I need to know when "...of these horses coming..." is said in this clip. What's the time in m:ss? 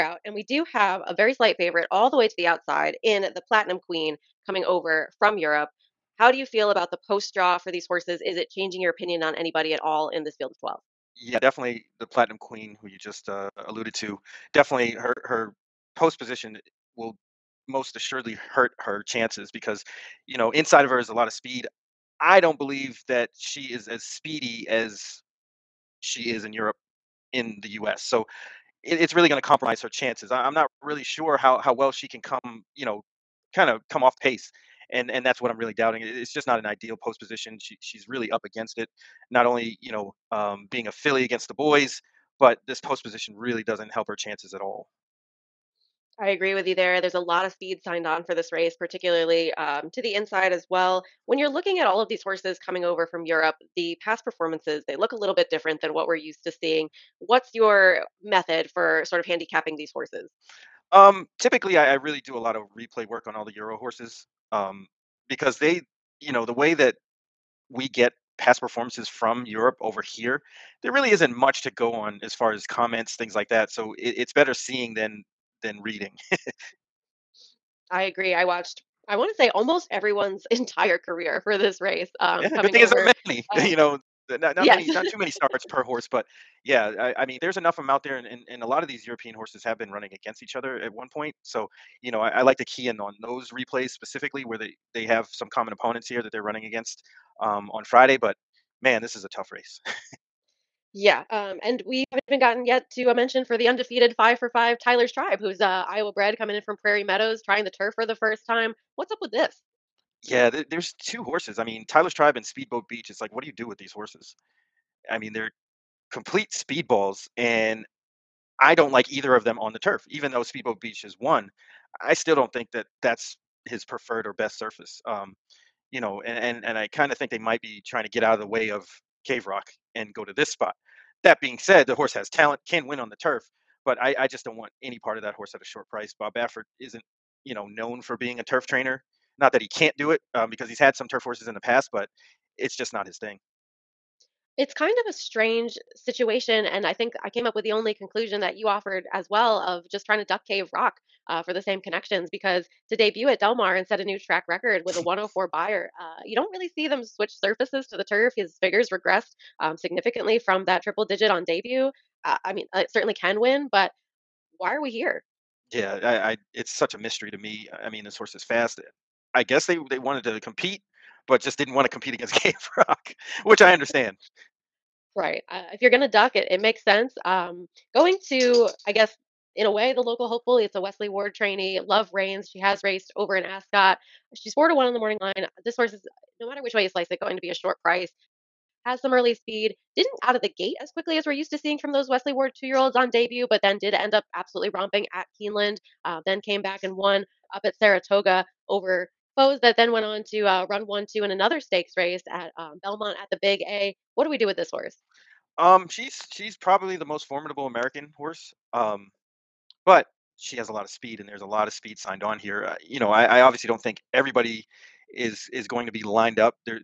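0:51.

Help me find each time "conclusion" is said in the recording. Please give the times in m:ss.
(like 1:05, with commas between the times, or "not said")
2:27.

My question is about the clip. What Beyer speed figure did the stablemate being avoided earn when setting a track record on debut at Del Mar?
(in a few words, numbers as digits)
104.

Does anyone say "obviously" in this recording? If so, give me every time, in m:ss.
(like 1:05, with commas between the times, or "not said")
3:33.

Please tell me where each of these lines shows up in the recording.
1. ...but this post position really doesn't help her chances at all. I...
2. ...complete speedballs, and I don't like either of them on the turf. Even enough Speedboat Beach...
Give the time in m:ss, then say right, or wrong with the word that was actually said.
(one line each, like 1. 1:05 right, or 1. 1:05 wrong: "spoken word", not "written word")
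1. 0:42 right
2. 1:56 wrong: "though", not "enough".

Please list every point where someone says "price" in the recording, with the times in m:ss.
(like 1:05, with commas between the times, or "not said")
2:15, 3:07.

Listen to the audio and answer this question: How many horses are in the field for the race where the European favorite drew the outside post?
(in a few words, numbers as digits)
12.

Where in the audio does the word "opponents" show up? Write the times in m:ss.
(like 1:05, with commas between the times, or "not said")
1:35.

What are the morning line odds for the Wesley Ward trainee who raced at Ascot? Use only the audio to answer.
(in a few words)
4-1.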